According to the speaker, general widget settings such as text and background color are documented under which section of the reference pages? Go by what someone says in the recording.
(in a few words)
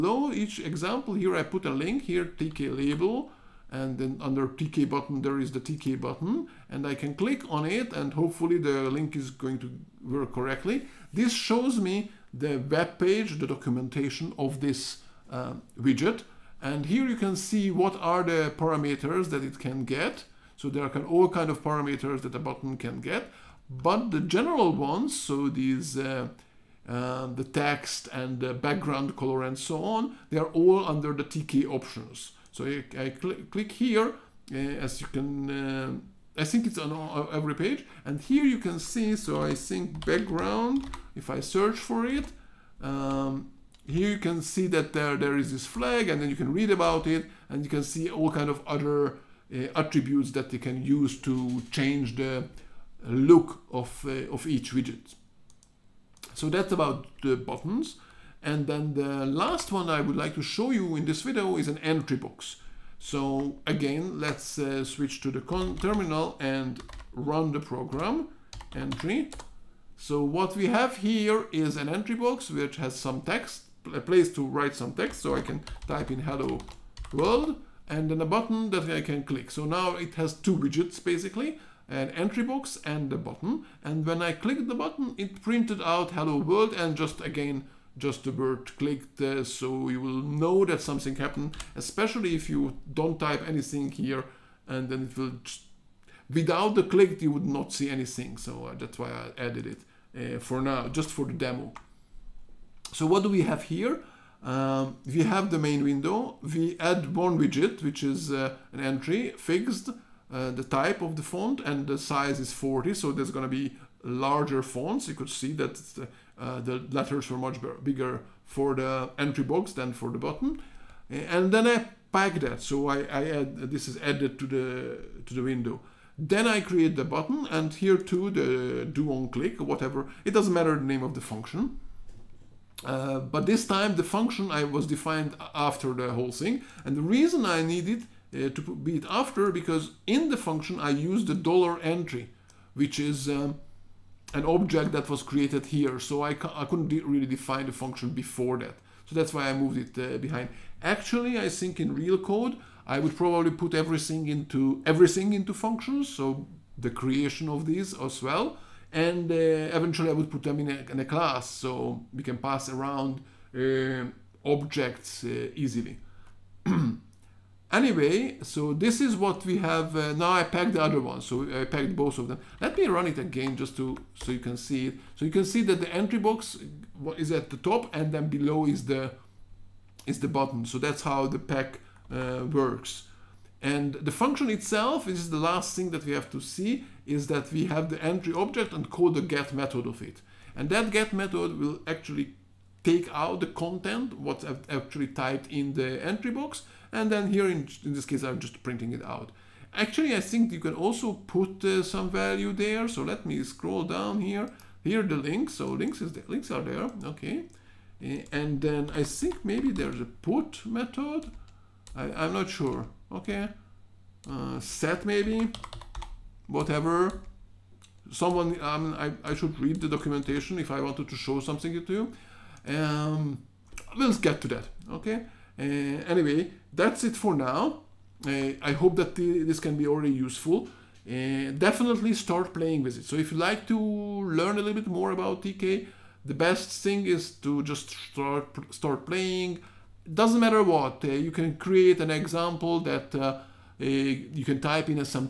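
TK options.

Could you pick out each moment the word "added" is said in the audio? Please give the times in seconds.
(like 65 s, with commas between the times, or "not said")
99 s, 123 s.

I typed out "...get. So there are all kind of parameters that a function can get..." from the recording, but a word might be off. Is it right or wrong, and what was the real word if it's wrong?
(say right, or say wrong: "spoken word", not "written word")
wrong: "button", not "function".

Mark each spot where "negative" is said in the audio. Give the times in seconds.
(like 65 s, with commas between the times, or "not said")
not said.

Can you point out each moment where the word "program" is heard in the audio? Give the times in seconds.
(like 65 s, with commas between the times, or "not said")
67 s.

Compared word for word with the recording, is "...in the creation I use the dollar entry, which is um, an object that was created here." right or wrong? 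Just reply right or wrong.
wrong.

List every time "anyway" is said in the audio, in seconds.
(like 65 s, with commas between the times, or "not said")
167 s, 226 s.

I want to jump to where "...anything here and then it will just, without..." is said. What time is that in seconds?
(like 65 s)
93 s.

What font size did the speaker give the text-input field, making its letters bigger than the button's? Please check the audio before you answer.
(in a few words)
40.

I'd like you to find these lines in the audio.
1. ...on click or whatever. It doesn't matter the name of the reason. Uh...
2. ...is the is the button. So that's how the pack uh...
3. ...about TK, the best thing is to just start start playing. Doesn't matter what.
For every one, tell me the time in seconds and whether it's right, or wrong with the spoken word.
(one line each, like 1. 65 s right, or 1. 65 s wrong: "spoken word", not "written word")
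1. 129 s wrong: "function", not "reason"
2. 178 s right
3. 235 s right.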